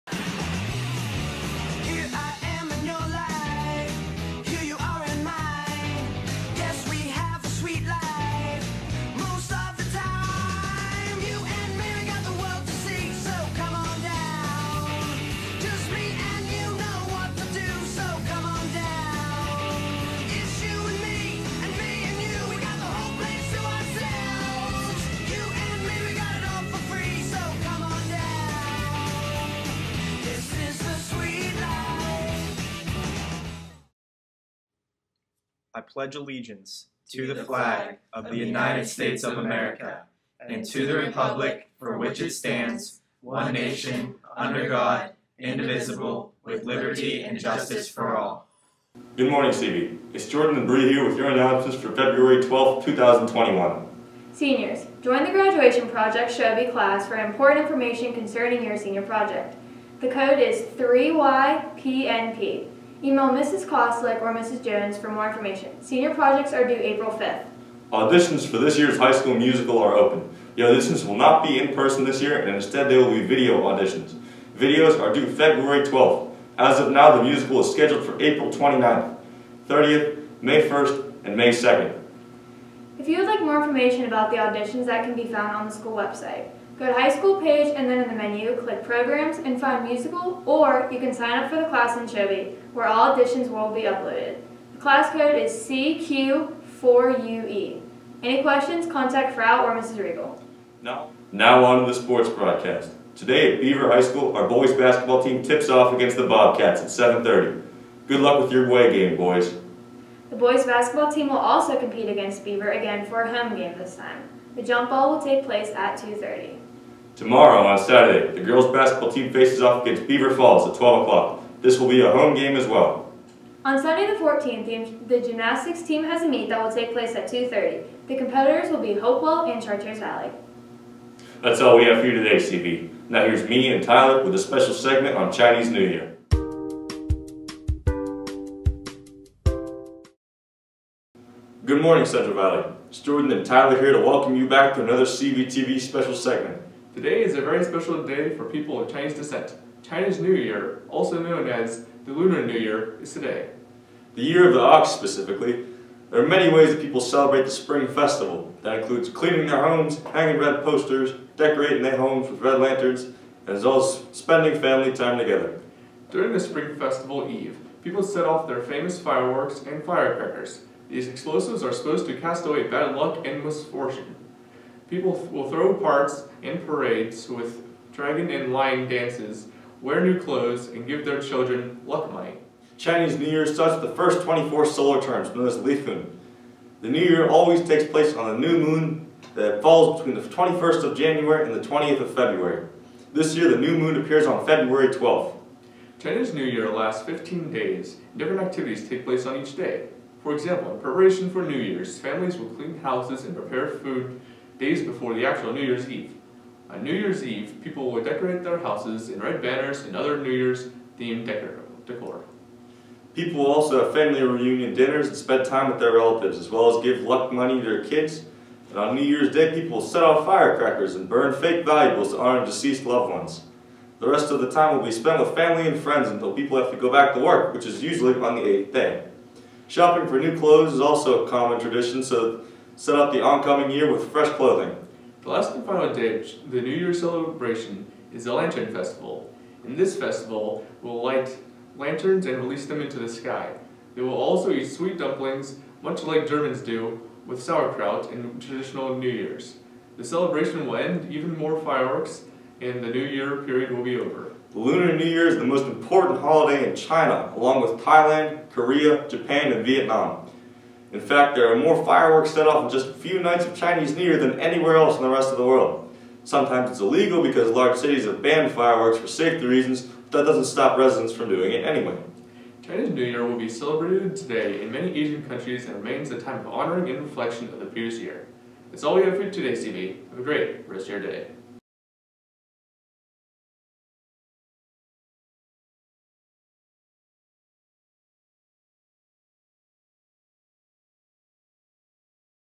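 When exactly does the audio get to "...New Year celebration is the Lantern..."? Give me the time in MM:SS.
03:56.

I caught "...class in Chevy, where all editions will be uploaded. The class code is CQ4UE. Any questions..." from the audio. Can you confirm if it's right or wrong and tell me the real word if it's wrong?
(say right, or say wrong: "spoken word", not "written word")
right.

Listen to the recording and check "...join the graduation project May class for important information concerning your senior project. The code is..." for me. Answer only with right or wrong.
wrong.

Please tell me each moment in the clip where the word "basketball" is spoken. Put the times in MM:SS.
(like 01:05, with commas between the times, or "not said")
01:44, 01:50, 01:58.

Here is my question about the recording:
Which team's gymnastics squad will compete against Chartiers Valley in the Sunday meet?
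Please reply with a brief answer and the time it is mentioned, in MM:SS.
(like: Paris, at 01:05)
Hopewell, at 02:08.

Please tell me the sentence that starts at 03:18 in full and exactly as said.
and Different activities take place on each day.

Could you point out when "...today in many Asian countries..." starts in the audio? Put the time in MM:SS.
04:34.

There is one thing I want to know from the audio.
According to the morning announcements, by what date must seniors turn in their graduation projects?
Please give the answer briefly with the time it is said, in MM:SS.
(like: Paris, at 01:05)
April 5th, at 01:06.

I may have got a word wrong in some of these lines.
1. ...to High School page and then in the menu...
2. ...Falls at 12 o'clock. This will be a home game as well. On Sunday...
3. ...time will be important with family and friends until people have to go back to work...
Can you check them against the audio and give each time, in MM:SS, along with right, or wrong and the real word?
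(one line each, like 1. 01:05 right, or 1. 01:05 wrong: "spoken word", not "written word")
1. 01:26 right
2. 02:00 right
3. 03:44 wrong: "spent", not "important".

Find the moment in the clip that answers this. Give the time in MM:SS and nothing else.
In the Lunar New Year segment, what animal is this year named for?
02:34.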